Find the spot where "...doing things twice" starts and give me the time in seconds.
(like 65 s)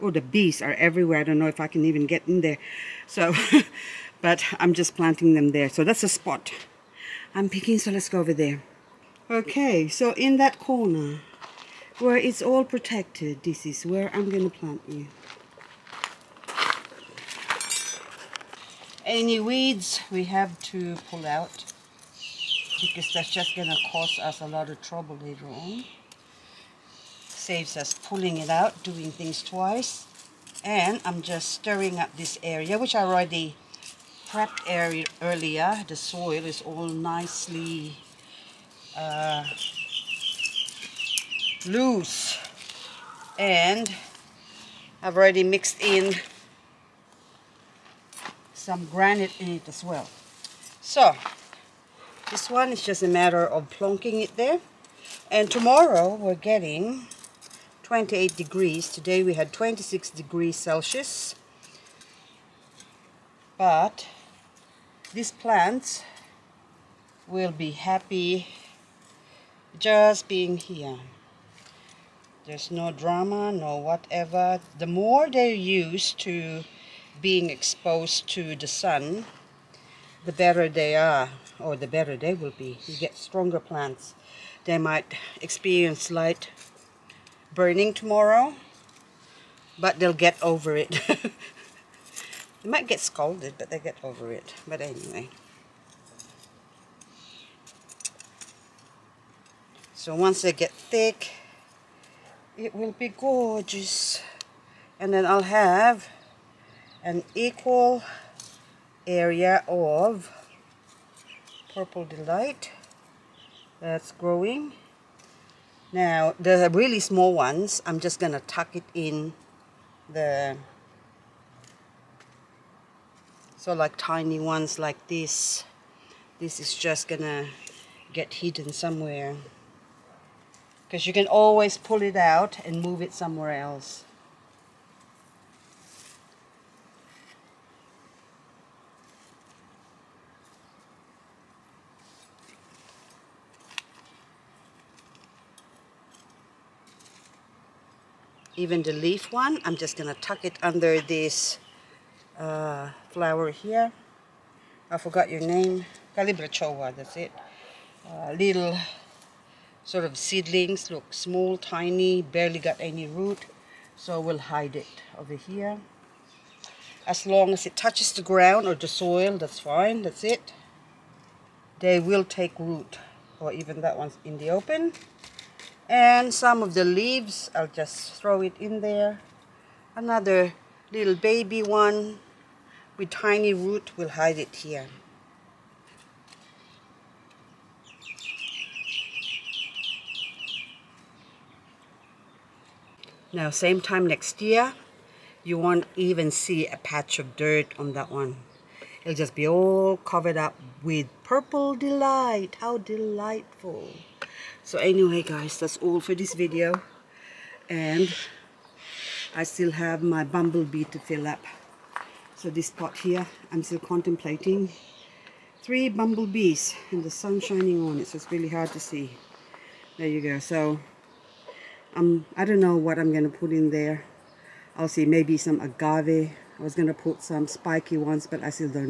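28 s.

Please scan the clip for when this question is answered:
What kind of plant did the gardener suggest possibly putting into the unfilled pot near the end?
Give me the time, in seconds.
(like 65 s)
225 s.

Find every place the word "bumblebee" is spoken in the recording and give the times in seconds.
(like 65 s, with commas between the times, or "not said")
210 s, 215 s.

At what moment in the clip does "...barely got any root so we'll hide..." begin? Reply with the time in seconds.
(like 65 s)
162 s.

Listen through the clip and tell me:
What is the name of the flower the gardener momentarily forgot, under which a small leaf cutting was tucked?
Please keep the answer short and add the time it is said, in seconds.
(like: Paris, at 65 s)
Calibrachoa, at 156 s.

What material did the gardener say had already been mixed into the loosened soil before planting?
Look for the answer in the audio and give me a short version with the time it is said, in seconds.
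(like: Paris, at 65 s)
granite, at 48 s.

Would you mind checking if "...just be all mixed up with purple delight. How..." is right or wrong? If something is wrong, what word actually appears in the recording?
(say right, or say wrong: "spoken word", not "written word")
wrong: "covered", not "mixed".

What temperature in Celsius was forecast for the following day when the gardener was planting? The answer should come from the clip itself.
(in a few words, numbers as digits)
28 degrees.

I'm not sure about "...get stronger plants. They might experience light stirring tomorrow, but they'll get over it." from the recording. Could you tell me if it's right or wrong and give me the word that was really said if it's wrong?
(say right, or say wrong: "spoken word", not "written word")
wrong: "burning", not "stirring".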